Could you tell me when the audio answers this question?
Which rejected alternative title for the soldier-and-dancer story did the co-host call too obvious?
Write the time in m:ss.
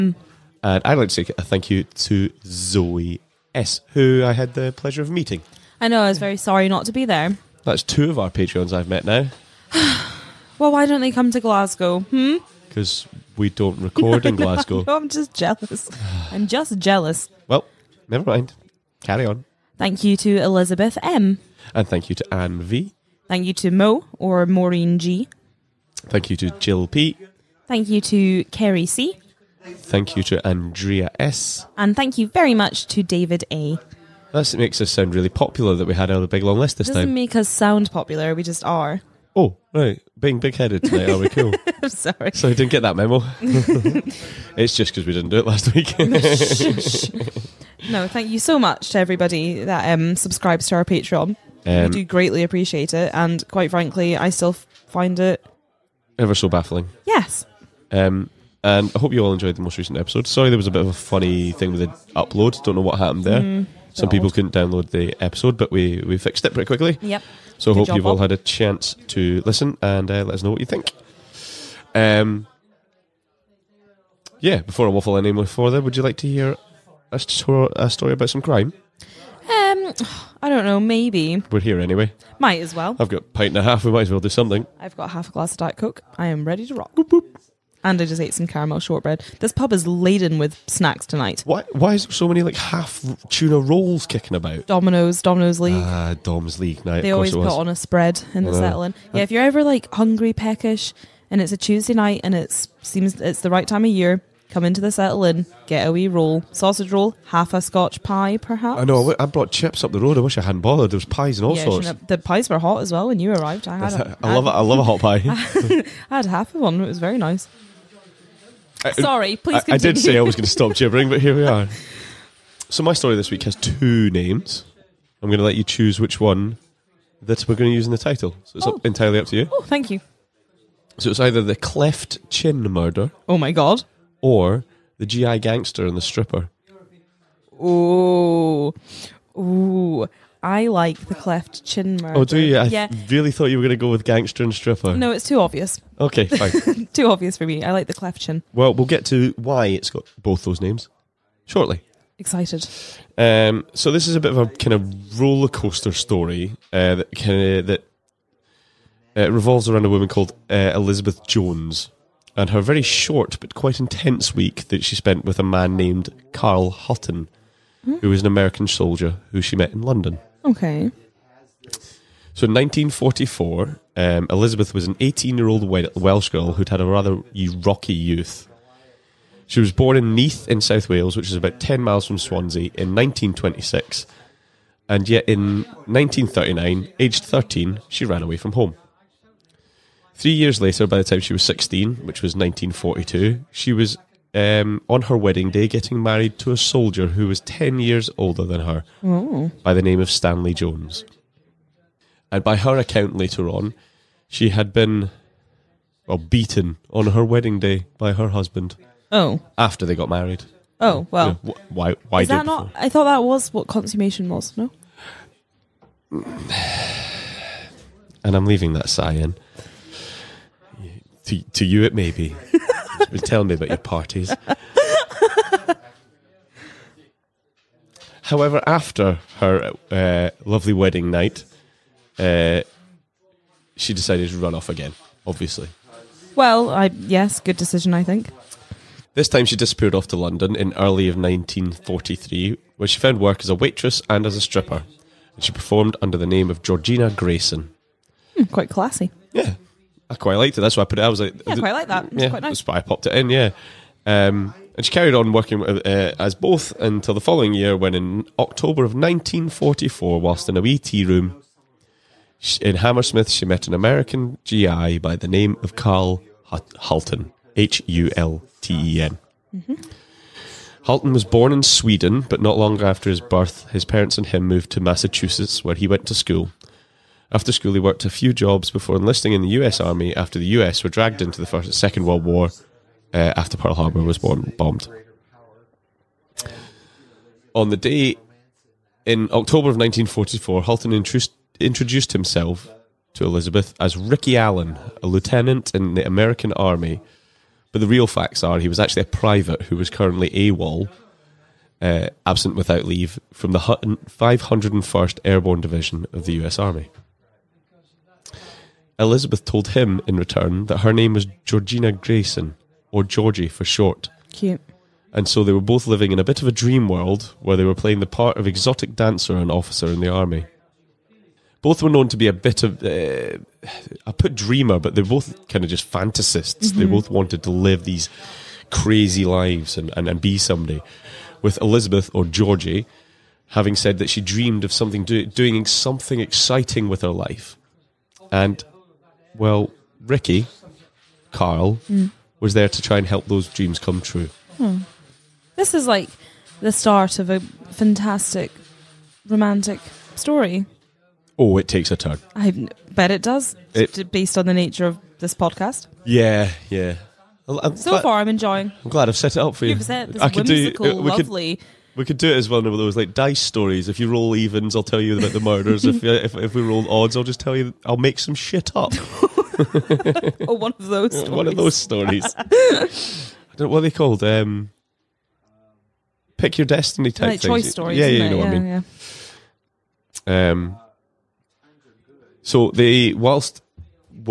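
2:15.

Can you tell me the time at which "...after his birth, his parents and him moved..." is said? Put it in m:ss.
4:32.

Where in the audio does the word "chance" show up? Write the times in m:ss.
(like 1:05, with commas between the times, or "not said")
1:08.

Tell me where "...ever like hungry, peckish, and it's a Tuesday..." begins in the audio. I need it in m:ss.
1:39.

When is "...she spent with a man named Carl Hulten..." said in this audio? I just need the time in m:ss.
2:44.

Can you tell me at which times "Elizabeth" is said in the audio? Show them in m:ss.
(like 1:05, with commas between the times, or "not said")
0:20, 2:40, 2:54, 4:53, 5:08, 5:31.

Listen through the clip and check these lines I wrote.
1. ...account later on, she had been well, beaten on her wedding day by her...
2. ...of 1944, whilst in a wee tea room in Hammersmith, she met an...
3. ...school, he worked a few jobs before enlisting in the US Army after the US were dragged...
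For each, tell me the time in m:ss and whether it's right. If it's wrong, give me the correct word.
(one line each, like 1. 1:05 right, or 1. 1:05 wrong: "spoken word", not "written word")
1. 3:22 right
2. 4:18 right
3. 4:37 right.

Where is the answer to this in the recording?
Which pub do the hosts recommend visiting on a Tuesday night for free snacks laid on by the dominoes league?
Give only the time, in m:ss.
1:44.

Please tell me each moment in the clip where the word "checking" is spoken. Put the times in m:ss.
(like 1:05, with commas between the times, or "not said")
not said.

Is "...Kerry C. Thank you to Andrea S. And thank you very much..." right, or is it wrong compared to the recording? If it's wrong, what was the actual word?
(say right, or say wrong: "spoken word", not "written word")
right.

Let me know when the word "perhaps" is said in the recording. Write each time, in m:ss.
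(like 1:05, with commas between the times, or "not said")
1:48.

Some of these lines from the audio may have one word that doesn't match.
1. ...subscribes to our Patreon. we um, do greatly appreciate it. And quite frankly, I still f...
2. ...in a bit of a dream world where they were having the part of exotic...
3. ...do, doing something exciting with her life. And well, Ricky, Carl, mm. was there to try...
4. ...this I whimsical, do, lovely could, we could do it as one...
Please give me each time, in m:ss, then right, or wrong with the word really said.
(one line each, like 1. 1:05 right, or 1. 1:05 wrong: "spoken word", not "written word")
1. 0:50 right
2. 5:16 wrong: "playing", not "having"
3. 5:35 right
4. 6:00 right.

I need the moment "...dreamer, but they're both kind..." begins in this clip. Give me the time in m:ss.
5:24.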